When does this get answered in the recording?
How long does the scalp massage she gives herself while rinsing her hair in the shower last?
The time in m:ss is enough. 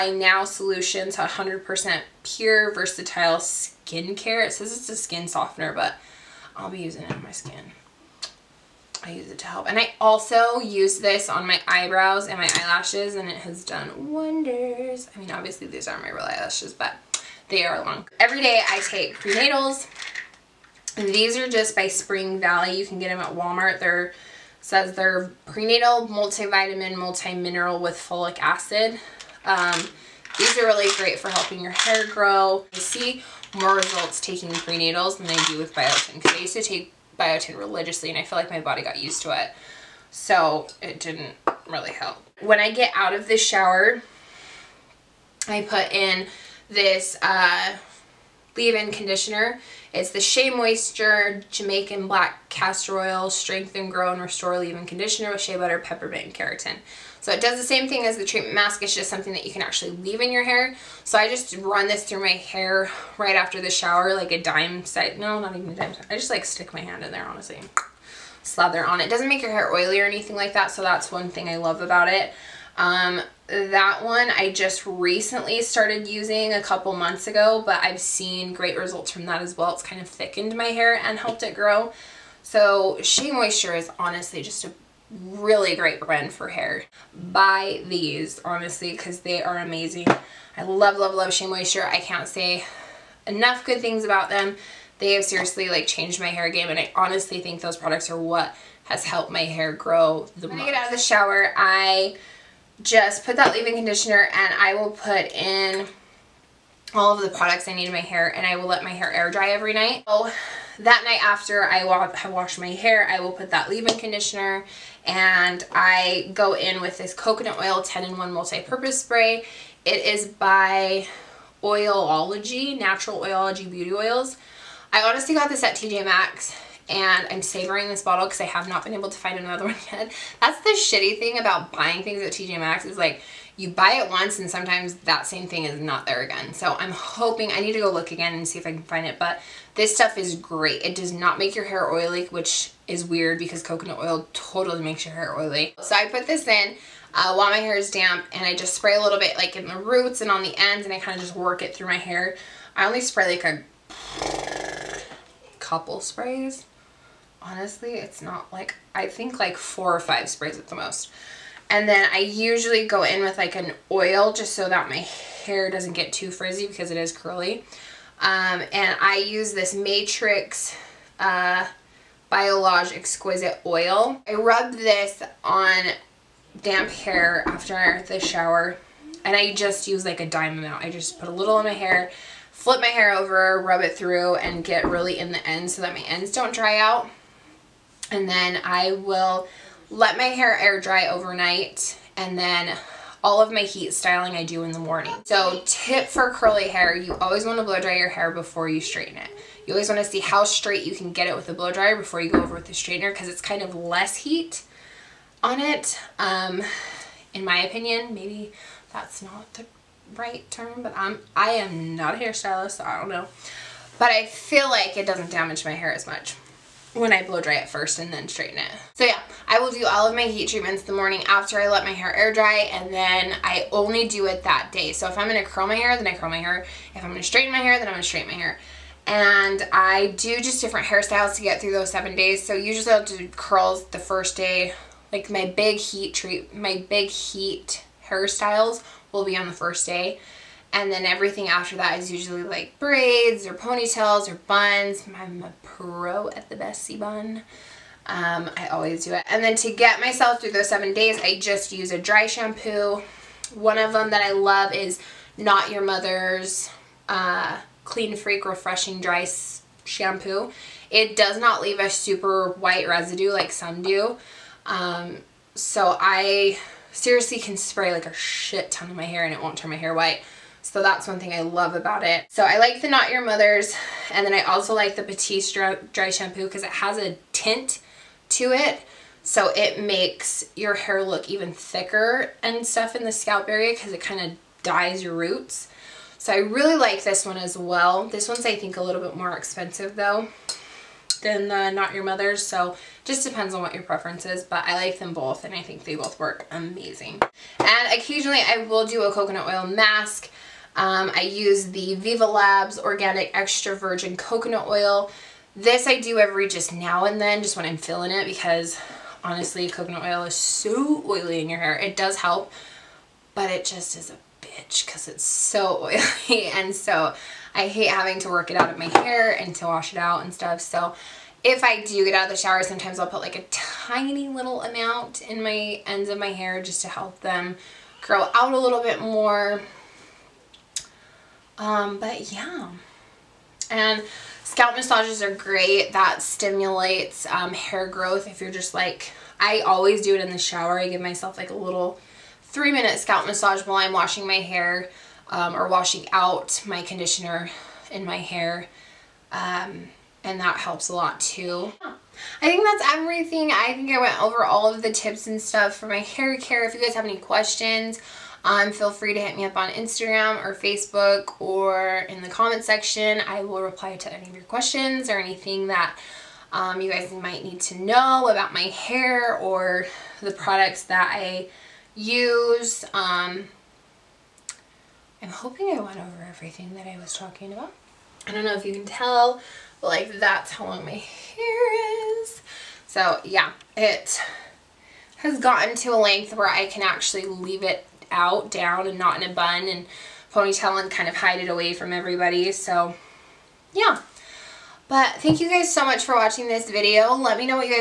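5:42.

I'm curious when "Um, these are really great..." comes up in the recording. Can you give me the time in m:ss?
0:29.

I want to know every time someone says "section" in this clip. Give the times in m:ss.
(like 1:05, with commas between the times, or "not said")
6:02.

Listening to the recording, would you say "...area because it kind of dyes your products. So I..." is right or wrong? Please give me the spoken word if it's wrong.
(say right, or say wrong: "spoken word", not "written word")
wrong: "roots", not "products".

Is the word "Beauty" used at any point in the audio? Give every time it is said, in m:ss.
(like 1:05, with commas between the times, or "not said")
2:03.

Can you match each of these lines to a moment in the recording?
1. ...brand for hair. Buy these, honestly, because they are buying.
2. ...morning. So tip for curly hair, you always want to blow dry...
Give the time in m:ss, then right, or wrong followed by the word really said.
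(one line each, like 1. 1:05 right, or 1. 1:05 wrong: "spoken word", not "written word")
1. 1:25 wrong: "amazing", not "buying"
2. 3:14 right.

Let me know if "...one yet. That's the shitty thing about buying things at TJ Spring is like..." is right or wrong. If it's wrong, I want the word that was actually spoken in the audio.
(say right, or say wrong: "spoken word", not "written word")
wrong: "Maxx", not "Spring".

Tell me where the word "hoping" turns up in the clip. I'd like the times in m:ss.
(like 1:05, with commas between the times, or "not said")
2:16, 6:15.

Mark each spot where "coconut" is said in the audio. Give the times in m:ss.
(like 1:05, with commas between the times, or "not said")
1:57, 2:23, 4:59, 5:04, 5:09.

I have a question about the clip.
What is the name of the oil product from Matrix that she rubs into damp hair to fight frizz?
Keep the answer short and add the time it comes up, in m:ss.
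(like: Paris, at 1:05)
Biolage Exquisite Oil, at 2:52.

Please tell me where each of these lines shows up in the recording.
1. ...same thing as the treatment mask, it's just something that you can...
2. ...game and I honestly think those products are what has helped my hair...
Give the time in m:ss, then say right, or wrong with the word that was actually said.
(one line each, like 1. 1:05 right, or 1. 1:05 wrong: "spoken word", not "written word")
1. 0:57 right
2. 1:36 right.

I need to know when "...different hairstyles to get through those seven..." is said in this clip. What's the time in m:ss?
3:50.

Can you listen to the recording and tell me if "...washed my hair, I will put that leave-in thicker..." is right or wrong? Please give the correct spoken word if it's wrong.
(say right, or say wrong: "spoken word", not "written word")
wrong: "conditioner", not "thicker".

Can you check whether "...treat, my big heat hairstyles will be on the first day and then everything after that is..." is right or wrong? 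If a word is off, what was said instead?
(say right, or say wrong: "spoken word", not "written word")
right.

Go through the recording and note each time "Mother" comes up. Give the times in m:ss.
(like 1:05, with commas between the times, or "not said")
4:15, 4:33, 4:52.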